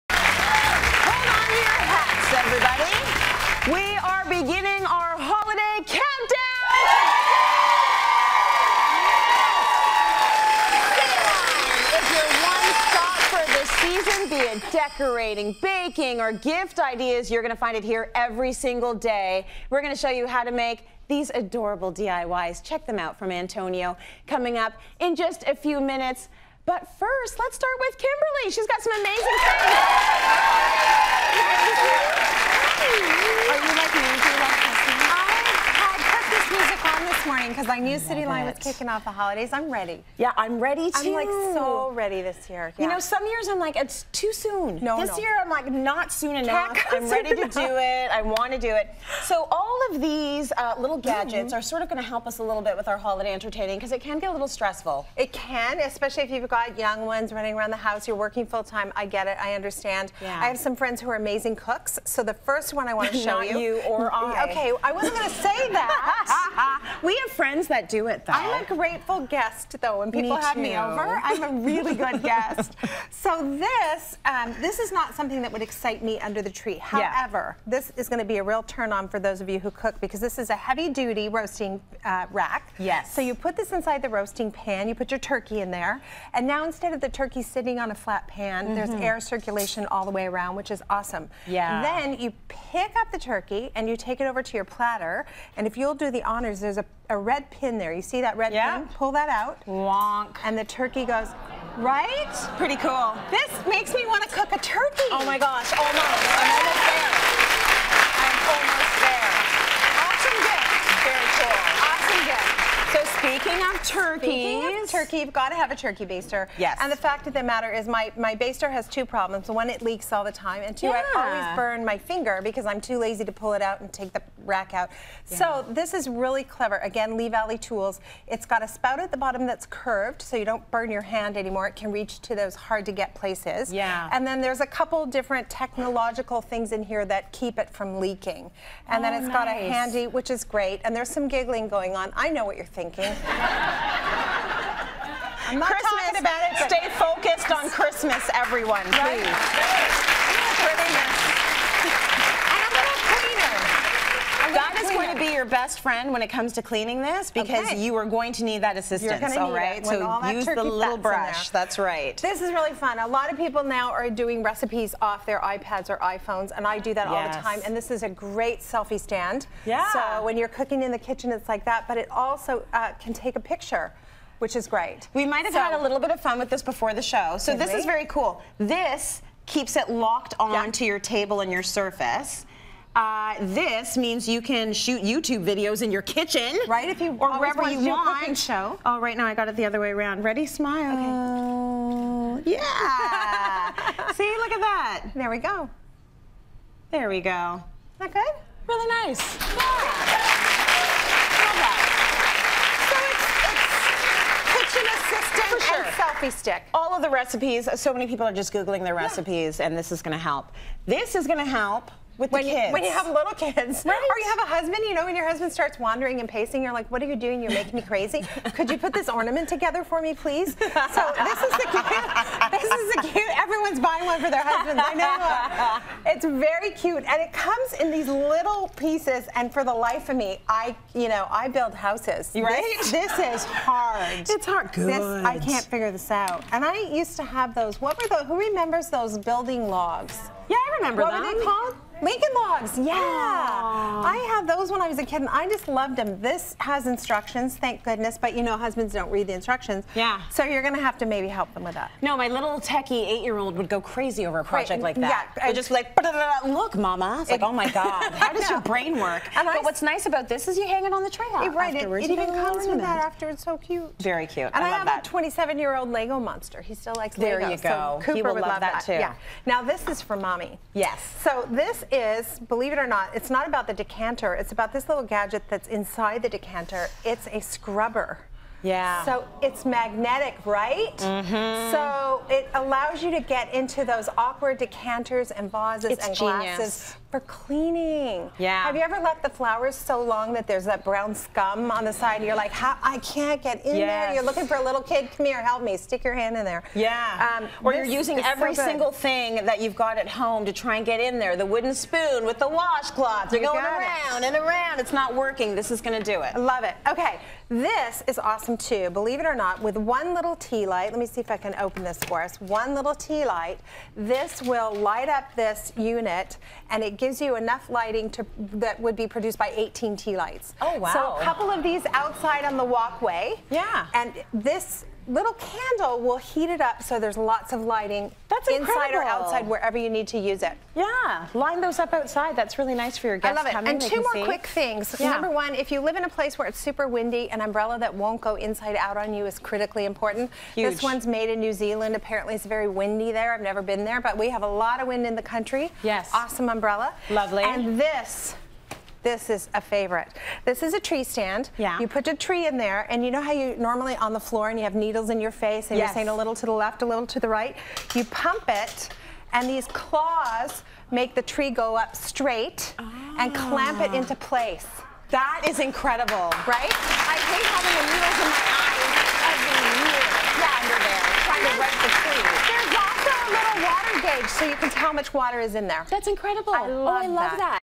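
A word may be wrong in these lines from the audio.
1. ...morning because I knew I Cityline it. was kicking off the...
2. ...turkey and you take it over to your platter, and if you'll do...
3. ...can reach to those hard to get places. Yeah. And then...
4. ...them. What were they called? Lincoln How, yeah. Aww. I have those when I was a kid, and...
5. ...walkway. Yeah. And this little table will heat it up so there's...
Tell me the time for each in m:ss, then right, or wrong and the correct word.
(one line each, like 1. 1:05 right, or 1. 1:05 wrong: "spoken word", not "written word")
1. 0:37 right
2. 1:33 right
3. 2:11 right
4. 4:01 wrong: "Logs", not "How"
5. 5:22 wrong: "candle", not "table".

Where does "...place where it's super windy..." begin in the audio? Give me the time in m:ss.
5:36.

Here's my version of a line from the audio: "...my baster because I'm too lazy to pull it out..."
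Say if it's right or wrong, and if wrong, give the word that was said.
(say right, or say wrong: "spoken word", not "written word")
wrong: "finger", not "baster".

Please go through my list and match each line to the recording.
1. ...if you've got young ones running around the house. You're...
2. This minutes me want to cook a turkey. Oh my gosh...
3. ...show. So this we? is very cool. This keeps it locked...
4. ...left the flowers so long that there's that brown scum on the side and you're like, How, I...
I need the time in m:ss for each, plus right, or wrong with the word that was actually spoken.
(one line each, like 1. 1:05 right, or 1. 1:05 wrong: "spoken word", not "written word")
1. 0:56 right
2. 1:43 wrong: "makes", not "minutes"
3. 2:57 right
4. 4:48 right.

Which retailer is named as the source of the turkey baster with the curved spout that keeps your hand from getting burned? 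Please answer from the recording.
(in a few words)
Lee Valley Tools.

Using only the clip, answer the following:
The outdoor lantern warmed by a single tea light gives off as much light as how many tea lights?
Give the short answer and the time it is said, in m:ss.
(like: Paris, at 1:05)
18, at 5:19.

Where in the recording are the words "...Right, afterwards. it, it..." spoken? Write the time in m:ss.
4:21.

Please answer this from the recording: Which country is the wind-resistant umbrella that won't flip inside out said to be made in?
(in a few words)
New Zealand.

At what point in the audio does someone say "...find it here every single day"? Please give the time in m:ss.
0:17.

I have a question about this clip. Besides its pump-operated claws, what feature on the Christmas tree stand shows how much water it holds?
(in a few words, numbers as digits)
water gauge.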